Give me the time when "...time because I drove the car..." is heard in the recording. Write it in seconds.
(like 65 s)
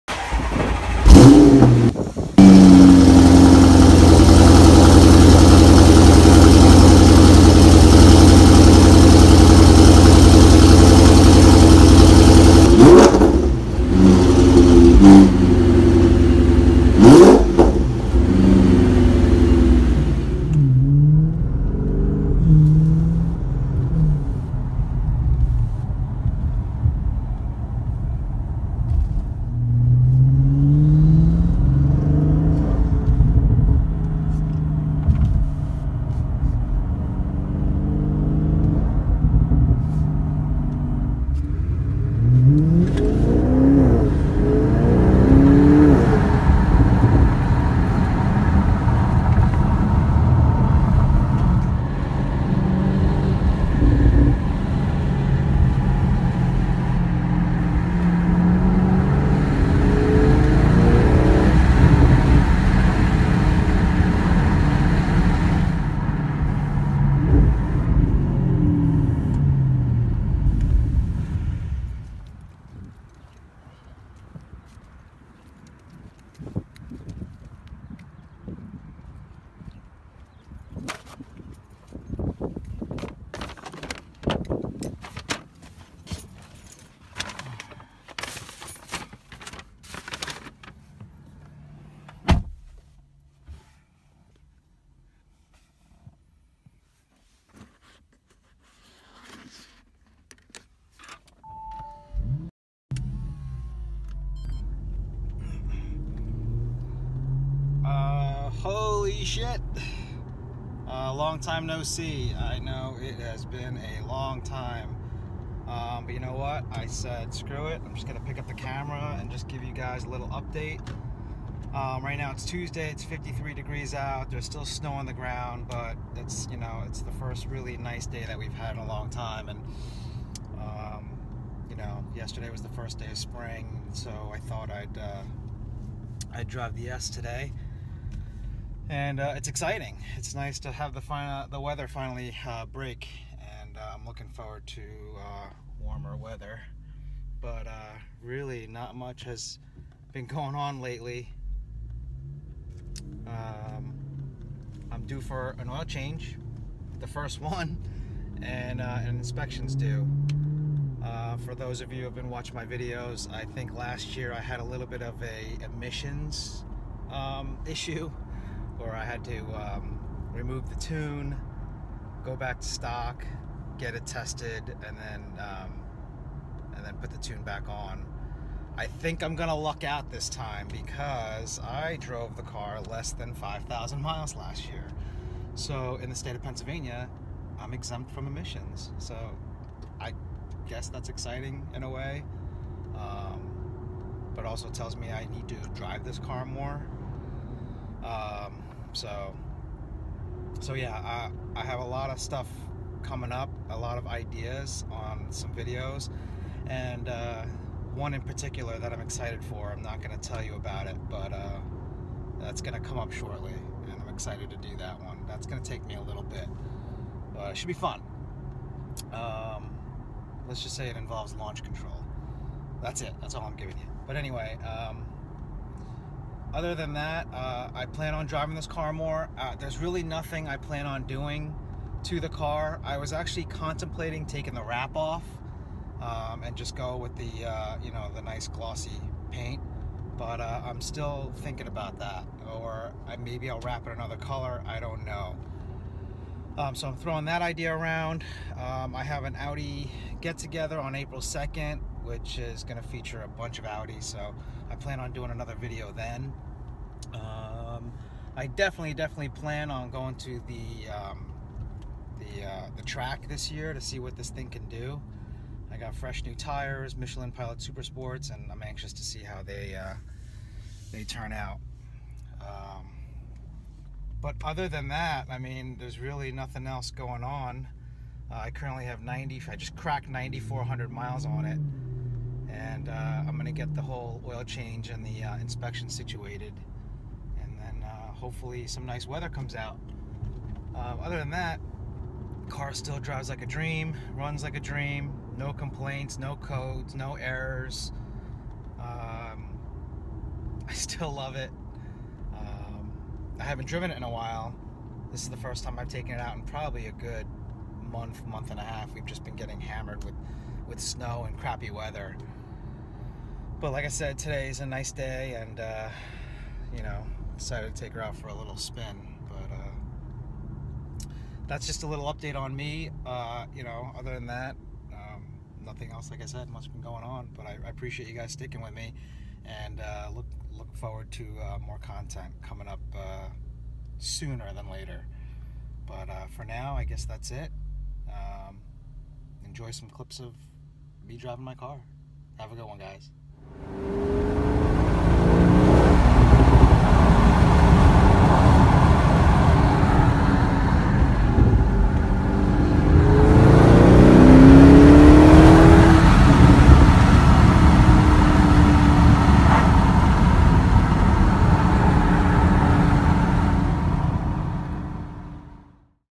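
180 s.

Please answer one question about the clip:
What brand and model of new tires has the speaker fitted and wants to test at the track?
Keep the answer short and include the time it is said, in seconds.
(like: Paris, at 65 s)
Michelin Pilot Super Sports, at 266 s.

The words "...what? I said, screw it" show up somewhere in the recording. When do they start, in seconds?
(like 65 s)
116 s.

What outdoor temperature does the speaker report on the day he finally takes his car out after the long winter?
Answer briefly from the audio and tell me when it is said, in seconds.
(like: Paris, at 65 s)
53 degrees, at 123 s.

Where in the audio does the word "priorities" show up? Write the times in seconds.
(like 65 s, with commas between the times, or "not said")
not said.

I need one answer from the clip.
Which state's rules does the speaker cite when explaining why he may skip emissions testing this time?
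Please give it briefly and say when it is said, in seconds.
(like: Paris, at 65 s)
Pennsylvania, at 186 s.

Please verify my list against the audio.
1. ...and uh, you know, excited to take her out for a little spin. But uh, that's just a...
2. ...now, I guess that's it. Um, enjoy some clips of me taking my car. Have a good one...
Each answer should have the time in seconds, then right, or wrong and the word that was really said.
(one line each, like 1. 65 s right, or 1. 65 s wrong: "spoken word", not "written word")
1. 315 s wrong: "decided", not "excited"
2. 336 s wrong: "driving", not "taking".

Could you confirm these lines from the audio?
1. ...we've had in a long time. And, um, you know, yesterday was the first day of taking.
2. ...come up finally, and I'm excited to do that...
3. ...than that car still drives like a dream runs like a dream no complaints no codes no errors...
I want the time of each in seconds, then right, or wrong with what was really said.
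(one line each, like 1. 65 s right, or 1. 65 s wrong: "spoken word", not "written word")
1. 128 s wrong: "spring", not "taking"
2. 212 s wrong: "shortly", not "finally"
3. 291 s right.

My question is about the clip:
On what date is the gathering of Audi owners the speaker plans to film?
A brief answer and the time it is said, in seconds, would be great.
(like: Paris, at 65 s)
April 2nd, at 250 s.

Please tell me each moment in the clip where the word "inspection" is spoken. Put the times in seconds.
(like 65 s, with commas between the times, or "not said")
159 s, 285 s.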